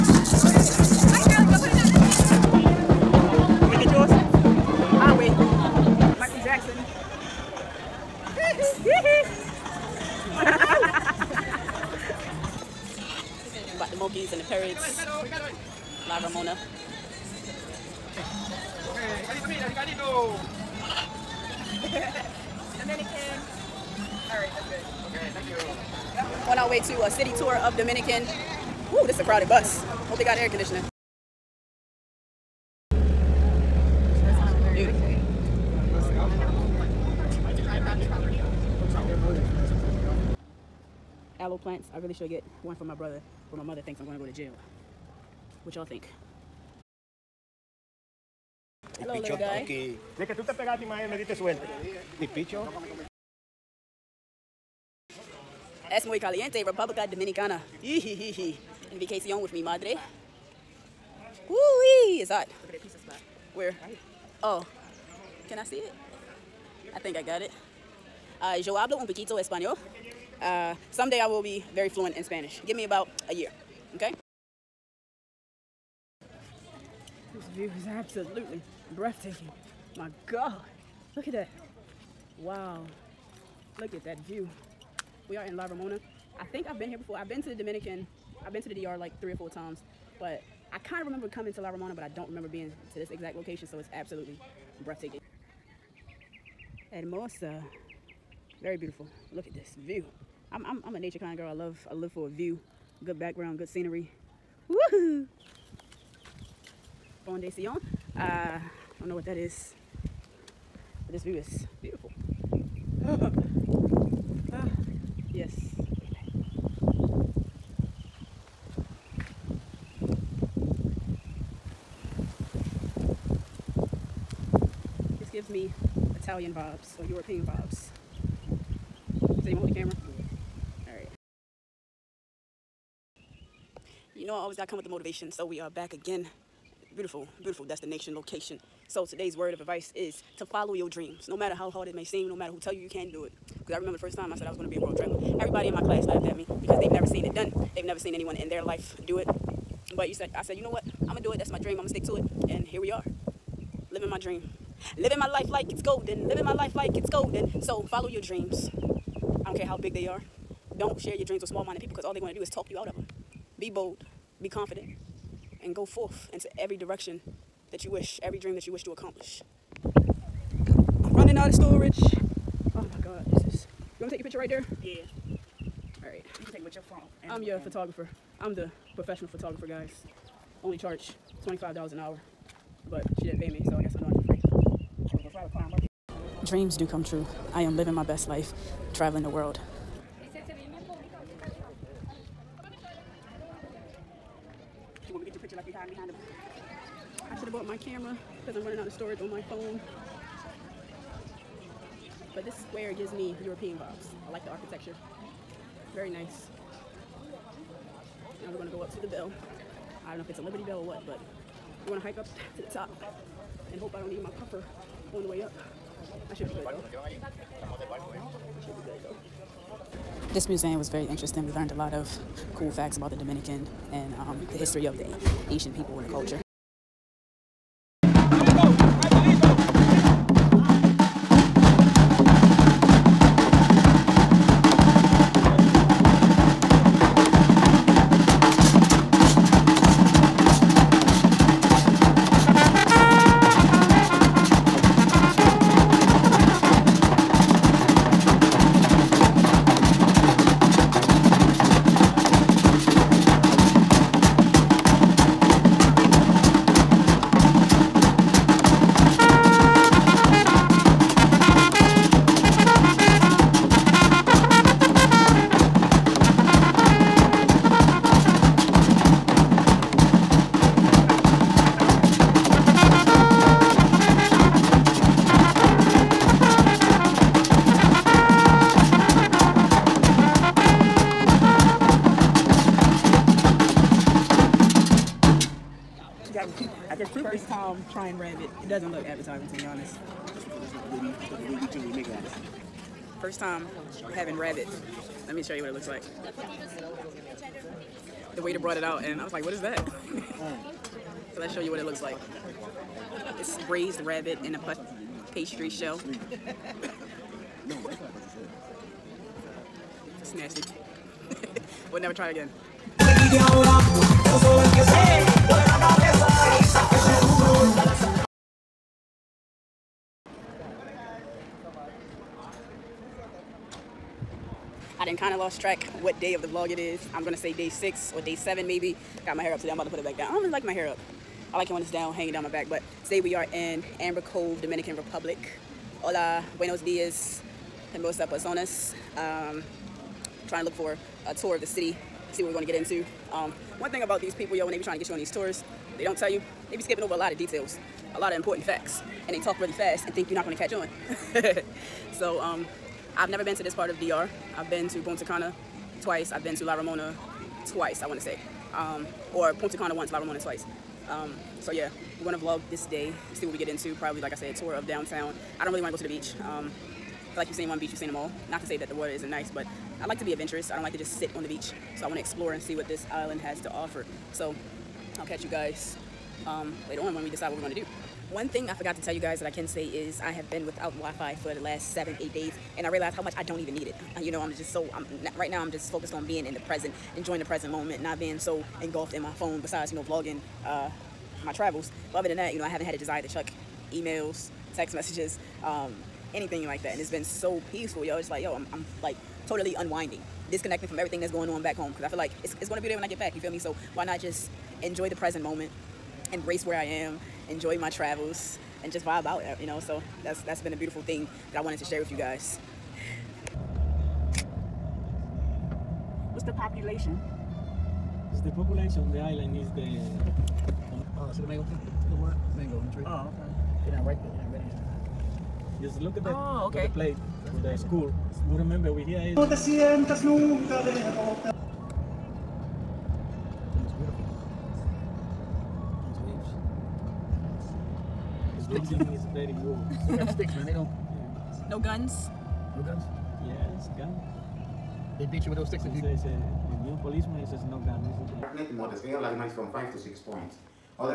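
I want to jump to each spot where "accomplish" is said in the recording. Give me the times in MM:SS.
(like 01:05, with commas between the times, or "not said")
02:48.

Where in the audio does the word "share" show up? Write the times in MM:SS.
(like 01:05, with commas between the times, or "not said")
02:40, 06:51.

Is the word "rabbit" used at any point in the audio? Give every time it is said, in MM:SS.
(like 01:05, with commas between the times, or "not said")
04:54, 05:03.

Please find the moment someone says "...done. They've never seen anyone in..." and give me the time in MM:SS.
02:27.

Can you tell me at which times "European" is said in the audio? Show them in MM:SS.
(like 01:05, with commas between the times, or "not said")
02:07, 03:23.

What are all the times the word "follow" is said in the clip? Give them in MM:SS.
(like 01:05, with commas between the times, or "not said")
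02:20, 02:37.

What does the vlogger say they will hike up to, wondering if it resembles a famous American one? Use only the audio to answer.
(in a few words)
The bell.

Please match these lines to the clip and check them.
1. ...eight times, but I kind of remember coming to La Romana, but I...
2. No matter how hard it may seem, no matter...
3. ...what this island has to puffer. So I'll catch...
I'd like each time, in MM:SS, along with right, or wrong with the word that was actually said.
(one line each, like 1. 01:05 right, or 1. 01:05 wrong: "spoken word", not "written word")
1. 01:29 wrong: "four", not "eight"
2. 02:21 right
3. 06:12 wrong: "offer", not "puffer".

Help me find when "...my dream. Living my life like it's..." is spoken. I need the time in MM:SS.
02:34.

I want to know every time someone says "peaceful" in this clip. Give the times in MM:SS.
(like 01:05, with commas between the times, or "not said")
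06:37.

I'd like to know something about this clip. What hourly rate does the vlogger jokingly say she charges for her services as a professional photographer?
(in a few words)
$25.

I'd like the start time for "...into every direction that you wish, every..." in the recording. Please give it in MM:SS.
02:46.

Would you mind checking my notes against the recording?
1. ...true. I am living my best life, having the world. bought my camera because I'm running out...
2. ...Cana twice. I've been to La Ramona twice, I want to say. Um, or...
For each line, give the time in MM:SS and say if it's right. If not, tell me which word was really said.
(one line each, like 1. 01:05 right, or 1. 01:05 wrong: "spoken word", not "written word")
1. 03:07 wrong: "traveling", not "having"
2. 05:55 right.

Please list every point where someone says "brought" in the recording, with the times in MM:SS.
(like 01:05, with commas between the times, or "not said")
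04:58.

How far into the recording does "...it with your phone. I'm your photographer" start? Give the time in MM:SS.
02:56.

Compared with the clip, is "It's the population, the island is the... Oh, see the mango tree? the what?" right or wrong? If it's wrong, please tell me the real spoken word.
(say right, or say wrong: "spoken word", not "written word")
right.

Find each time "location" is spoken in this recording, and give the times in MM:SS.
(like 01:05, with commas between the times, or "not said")
01:33, 02:18.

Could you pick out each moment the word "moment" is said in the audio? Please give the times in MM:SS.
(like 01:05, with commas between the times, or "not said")
06:27, 06:45.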